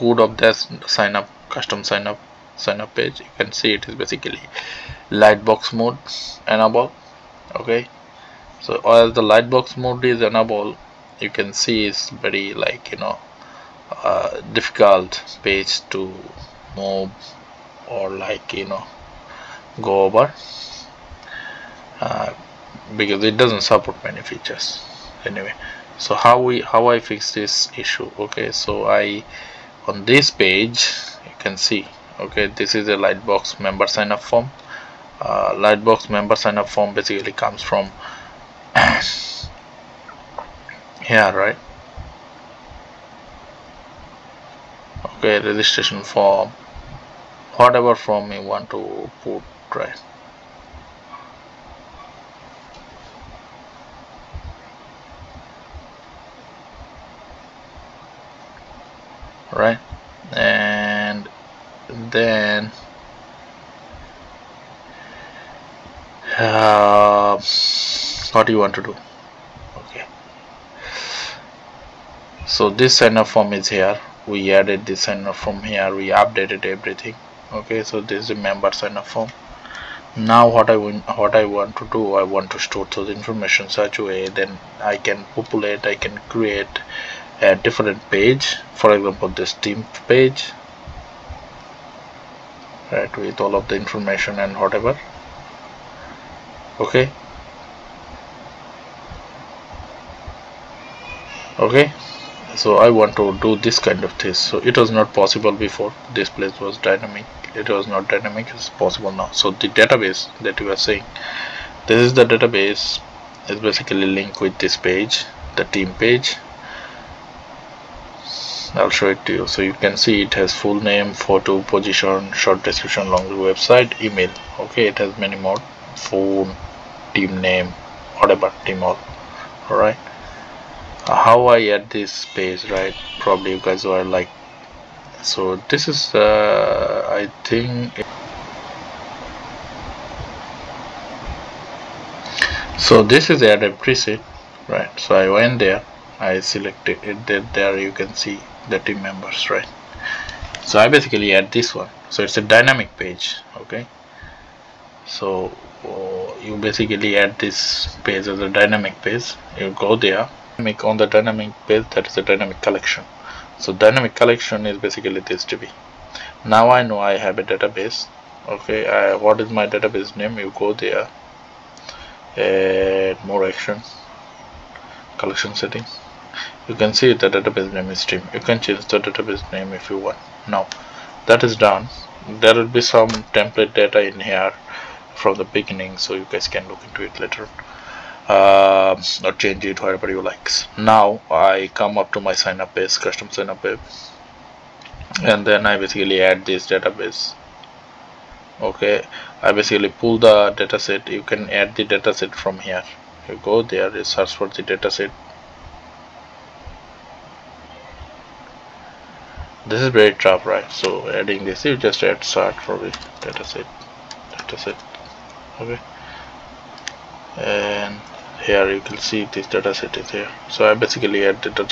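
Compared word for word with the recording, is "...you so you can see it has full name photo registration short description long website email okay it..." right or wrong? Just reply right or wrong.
wrong.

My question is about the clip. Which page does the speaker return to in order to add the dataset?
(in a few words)
custom sign up page.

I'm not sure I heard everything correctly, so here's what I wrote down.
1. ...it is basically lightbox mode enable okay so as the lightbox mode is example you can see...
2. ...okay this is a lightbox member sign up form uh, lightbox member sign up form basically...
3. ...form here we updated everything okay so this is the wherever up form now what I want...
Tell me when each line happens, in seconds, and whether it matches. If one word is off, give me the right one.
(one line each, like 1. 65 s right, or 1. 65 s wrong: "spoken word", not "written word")
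1. 3 s wrong: "enable", not "example"
2. 32 s right
3. 75 s wrong: "member", not "wherever".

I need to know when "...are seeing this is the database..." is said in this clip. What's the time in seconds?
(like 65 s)
110 s.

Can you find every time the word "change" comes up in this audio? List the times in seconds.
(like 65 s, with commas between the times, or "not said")
178 s, 189 s.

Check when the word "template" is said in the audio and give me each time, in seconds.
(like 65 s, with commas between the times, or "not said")
183 s.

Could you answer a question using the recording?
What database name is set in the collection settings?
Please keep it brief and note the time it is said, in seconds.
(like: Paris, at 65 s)
stream, at 177 s.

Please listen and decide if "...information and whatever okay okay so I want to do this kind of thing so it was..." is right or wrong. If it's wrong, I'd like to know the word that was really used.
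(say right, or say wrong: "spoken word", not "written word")
right.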